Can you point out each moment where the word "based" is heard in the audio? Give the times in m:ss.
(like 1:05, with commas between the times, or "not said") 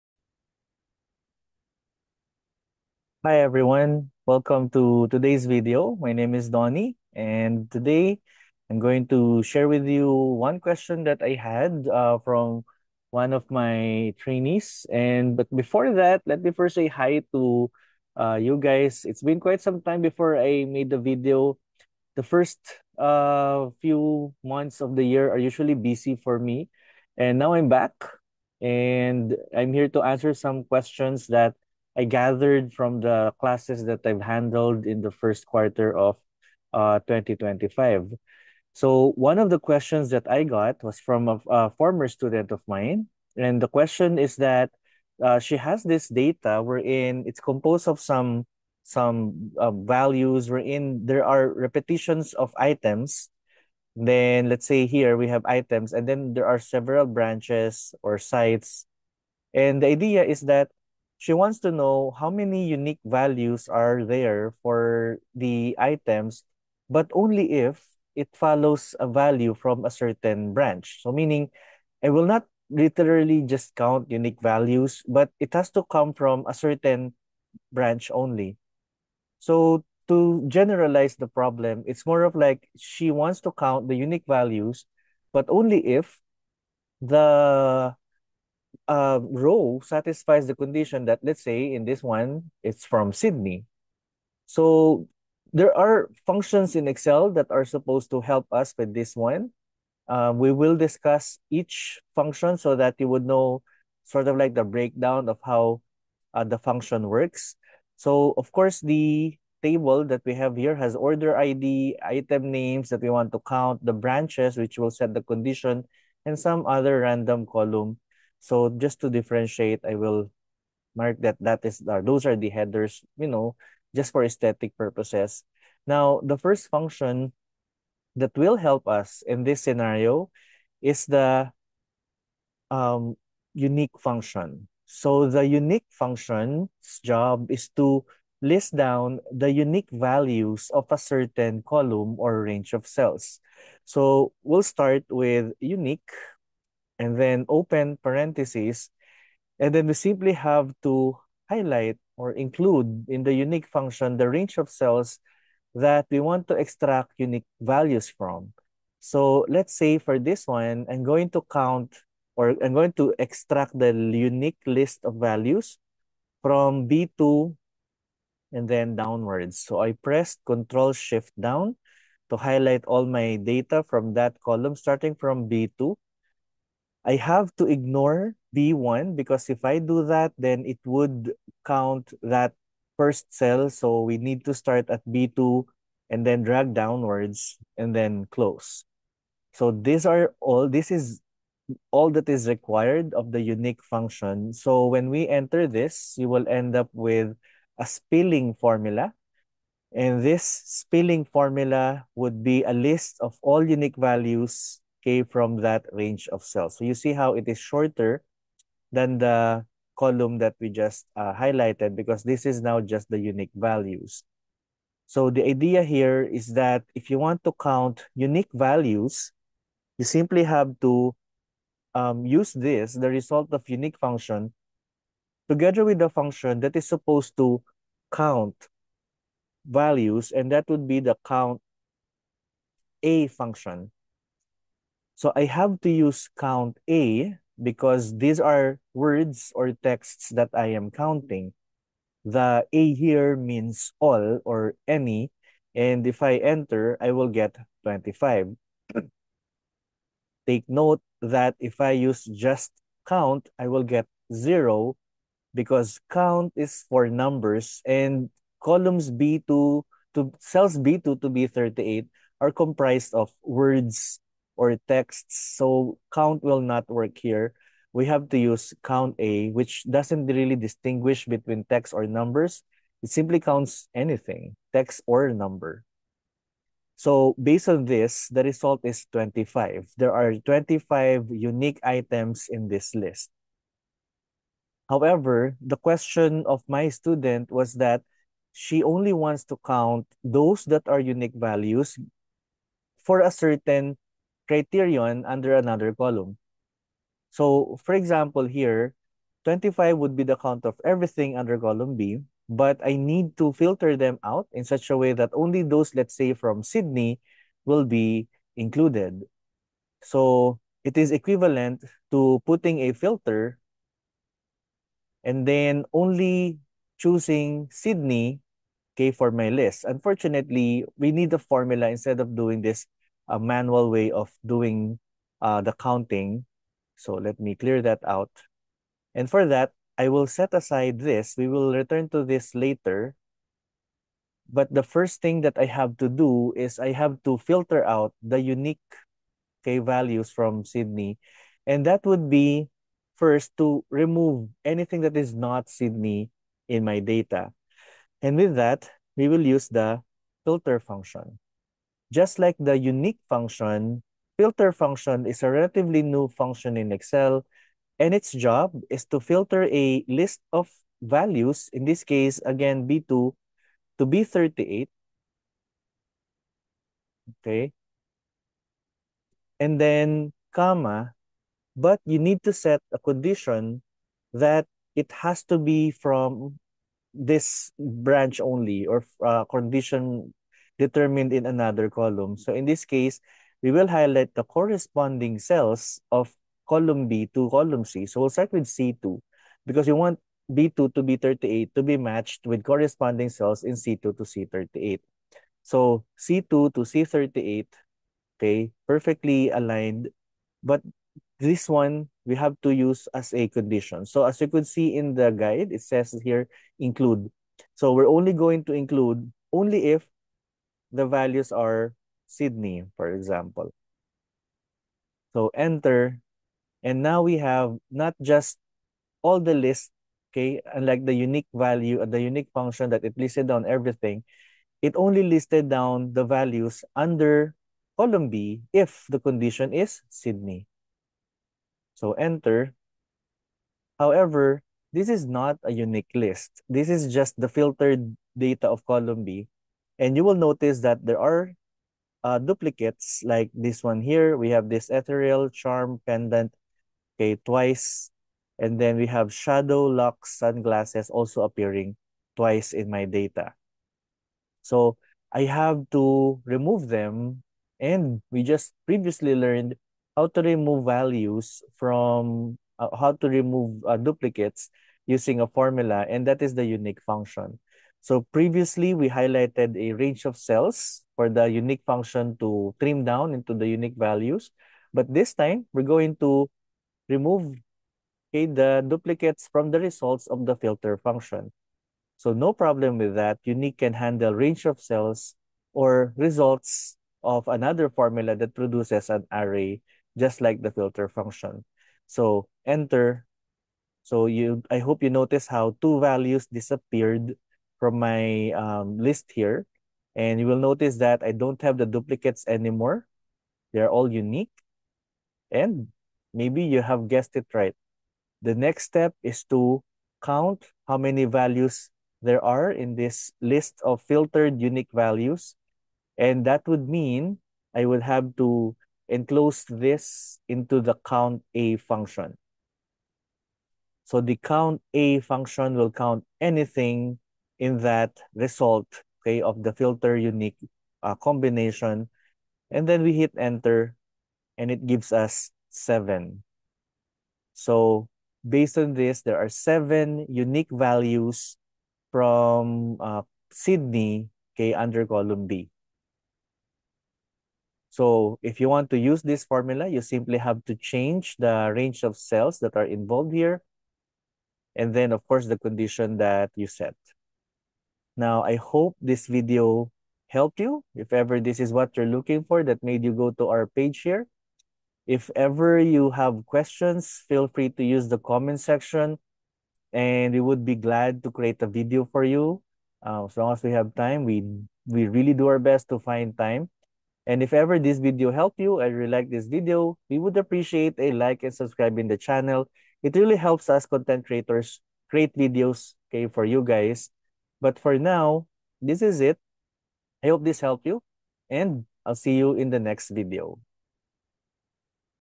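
4:37, 8:58.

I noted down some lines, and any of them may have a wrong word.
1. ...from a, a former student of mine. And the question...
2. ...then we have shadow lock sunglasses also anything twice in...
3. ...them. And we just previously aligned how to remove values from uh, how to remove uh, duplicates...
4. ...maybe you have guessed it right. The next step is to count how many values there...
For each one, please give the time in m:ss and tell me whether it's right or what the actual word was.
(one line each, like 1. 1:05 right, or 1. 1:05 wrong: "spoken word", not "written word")
1. 0:40 right
2. 7:28 wrong: "appearing", not "anything"
3. 7:36 wrong: "learned", not "aligned"
4. 8:26 right.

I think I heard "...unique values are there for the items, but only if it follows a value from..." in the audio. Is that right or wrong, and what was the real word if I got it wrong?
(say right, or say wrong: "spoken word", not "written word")
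right.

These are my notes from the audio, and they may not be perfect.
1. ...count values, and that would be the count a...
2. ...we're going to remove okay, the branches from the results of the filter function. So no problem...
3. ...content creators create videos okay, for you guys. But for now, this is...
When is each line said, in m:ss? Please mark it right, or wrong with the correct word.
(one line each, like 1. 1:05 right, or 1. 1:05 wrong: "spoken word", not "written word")
1. 3:48 right
2. 7:55 wrong: "duplicates", not "branches"
3. 9:43 right.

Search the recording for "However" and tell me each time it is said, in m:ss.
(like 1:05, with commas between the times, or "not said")
4:44, 7:13.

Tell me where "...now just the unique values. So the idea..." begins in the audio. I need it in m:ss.
3:32.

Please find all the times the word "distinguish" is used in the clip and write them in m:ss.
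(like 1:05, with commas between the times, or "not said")
4:30.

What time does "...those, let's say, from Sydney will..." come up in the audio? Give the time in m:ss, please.
5:05.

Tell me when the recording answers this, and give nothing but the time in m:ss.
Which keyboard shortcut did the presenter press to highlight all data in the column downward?
2:50.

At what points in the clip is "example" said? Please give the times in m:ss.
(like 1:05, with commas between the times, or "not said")
4:57, 6:53.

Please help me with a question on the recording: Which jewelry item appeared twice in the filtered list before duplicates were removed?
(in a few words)
Ethereal charm pendant.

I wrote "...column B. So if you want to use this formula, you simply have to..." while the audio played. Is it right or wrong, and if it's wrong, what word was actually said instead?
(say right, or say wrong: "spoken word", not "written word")
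right.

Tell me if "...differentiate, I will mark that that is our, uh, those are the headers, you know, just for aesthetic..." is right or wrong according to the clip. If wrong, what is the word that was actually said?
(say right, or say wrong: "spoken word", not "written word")
right.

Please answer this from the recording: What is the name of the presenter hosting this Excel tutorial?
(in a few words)
Donnie.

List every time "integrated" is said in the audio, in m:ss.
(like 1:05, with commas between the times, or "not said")
not said.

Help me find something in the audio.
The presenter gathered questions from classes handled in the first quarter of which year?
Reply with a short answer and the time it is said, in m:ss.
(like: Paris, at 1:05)
2025, at 0:37.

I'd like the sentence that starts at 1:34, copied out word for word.
So there are functions in Excel that are supposed to help us with this one.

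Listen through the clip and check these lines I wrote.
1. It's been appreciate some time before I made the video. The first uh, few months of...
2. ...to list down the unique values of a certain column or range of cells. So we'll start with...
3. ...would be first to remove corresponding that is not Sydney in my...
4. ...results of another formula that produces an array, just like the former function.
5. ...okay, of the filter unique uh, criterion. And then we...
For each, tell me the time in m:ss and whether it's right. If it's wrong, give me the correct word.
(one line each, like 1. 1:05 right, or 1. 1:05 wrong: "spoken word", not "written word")
1. 0:19 wrong: "quite", not "appreciate"
2. 2:17 right
3. 5:42 wrong: "anything", not "corresponding"
4. 8:06 wrong: "filter", not "former"
5. 8:49 wrong: "combination", not "criterion".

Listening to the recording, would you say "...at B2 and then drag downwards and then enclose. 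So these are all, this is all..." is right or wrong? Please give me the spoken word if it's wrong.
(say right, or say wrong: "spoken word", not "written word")
wrong: "close", not "enclose".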